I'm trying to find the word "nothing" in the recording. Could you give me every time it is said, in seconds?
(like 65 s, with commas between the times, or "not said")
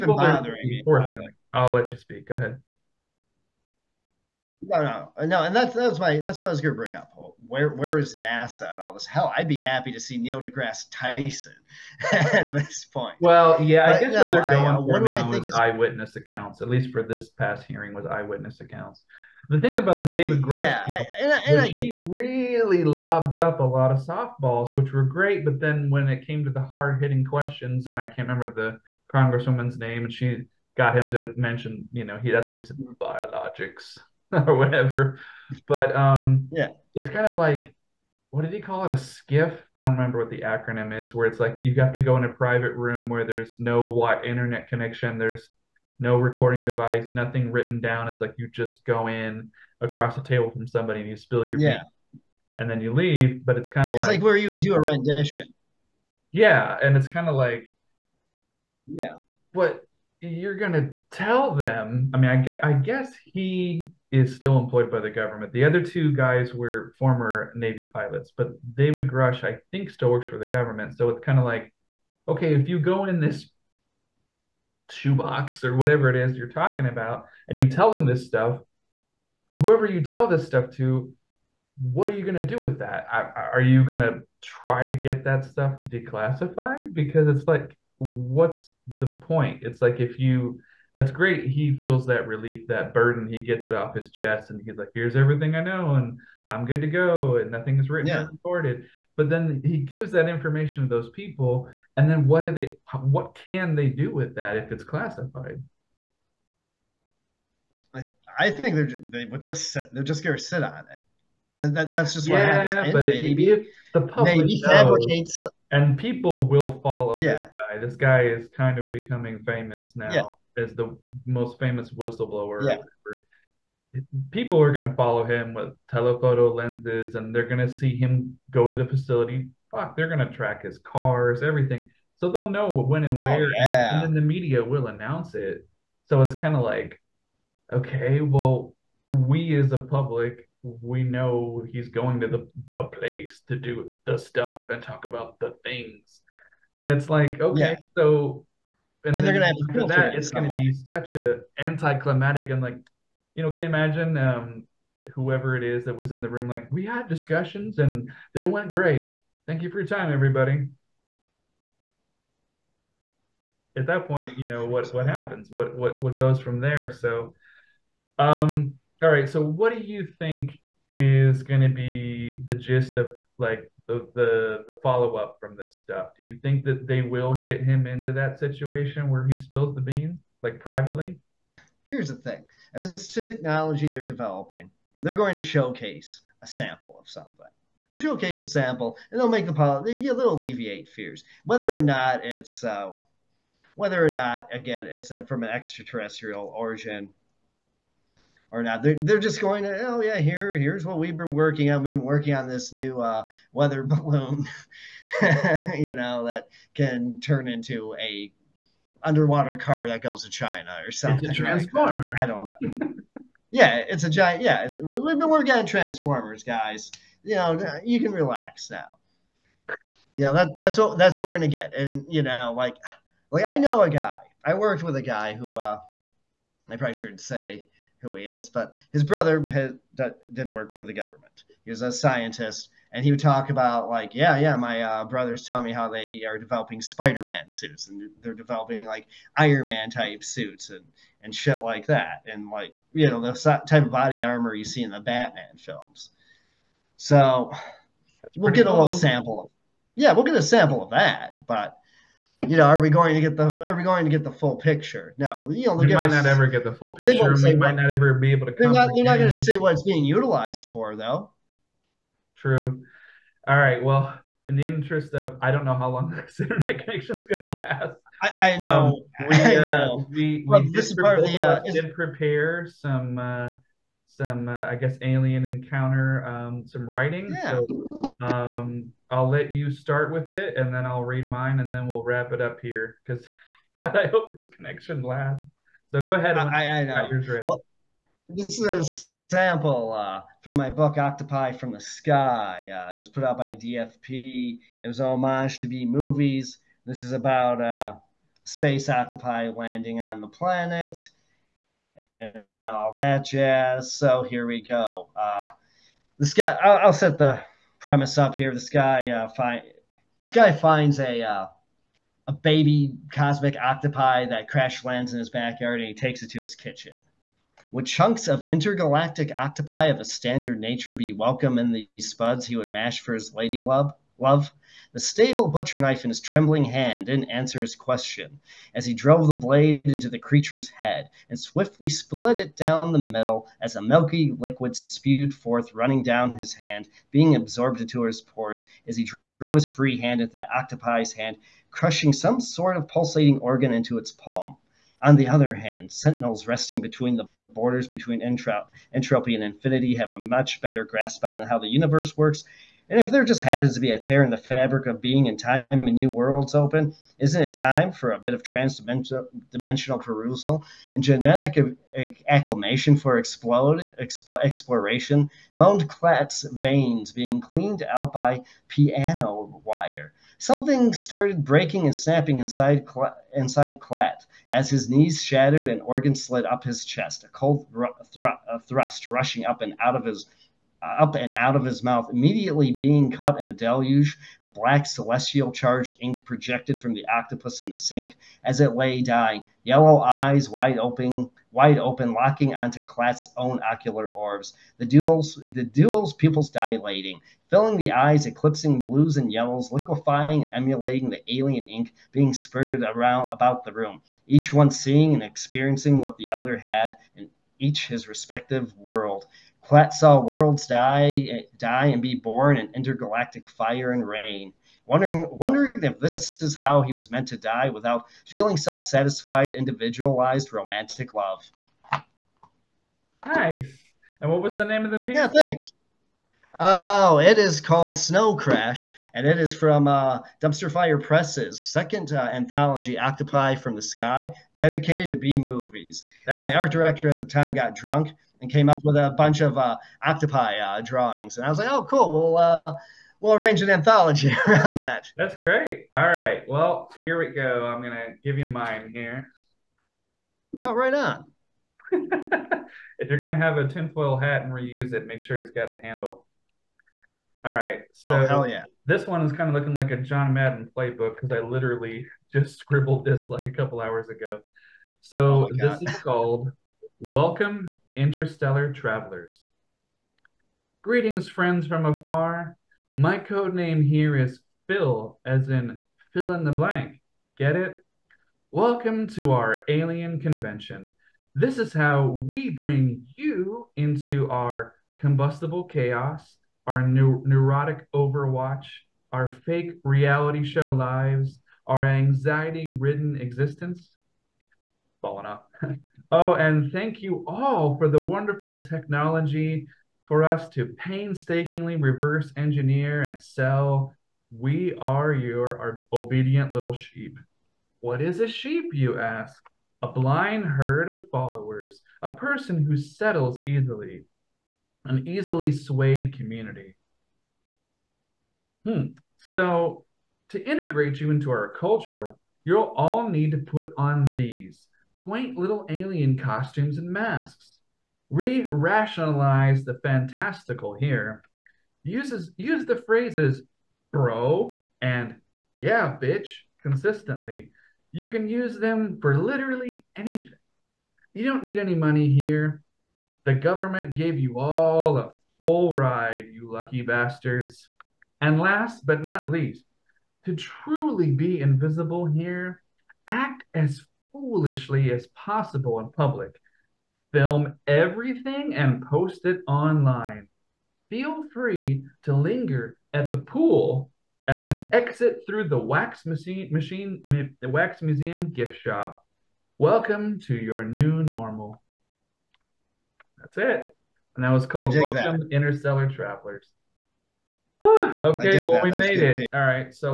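47 s, 97 s.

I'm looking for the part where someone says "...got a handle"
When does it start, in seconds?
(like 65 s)
455 s.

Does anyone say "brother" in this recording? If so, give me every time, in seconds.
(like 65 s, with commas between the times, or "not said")
229 s, 235 s.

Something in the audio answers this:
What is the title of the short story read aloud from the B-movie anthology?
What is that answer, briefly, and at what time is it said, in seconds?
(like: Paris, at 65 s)
Snow Crash, at 427 s.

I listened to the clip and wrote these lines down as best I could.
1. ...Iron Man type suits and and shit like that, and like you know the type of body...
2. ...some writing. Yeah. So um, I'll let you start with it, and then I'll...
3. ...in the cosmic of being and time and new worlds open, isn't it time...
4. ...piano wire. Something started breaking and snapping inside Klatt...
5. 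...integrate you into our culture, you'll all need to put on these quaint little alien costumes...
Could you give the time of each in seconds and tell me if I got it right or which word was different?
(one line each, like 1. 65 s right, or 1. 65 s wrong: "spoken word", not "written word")
1. 239 s right
2. 276 s right
3. 354 s wrong: "fabric", not "cosmic"
4. 368 s right
5. 520 s right.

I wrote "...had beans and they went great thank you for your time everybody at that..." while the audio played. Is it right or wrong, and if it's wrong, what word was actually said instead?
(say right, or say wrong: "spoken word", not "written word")
wrong: "discussions", not "beans".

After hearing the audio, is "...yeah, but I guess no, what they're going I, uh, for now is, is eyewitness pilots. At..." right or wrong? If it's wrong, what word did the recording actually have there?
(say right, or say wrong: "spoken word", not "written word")
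wrong: "accounts", not "pilots".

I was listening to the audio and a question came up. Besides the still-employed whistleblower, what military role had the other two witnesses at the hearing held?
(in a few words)
Navy pilots.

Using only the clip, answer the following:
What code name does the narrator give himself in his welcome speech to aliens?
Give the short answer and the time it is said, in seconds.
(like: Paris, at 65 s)
Phil, at 474 s.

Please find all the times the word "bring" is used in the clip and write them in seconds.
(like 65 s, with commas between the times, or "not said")
6 s, 482 s.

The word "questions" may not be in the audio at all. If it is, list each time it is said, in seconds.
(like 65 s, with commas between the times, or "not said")
27 s, 327 s.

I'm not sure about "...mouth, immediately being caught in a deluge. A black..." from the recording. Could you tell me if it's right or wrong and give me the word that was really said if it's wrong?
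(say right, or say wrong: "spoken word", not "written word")
right.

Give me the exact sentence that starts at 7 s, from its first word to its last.
Where where is NASA and all this?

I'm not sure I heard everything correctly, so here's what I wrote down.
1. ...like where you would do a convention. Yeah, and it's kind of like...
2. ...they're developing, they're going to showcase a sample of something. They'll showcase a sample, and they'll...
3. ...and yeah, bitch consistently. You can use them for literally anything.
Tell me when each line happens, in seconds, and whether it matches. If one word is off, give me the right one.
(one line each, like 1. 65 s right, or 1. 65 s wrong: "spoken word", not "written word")
1. 54 s wrong: "rendition", not "convention"
2. 183 s right
3. 534 s right.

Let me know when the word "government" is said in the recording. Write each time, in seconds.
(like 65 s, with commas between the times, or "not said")
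65 s, 70 s, 230 s, 543 s.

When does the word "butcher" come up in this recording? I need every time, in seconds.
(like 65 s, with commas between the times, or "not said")
325 s.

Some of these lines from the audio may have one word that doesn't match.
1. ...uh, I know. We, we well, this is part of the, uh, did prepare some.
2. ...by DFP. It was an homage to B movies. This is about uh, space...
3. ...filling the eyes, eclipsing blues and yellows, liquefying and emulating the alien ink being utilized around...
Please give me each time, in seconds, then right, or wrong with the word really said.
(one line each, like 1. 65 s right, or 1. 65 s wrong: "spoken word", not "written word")
1. 269 s right
2. 293 s right
3. 397 s wrong: "spurted", not "utilized".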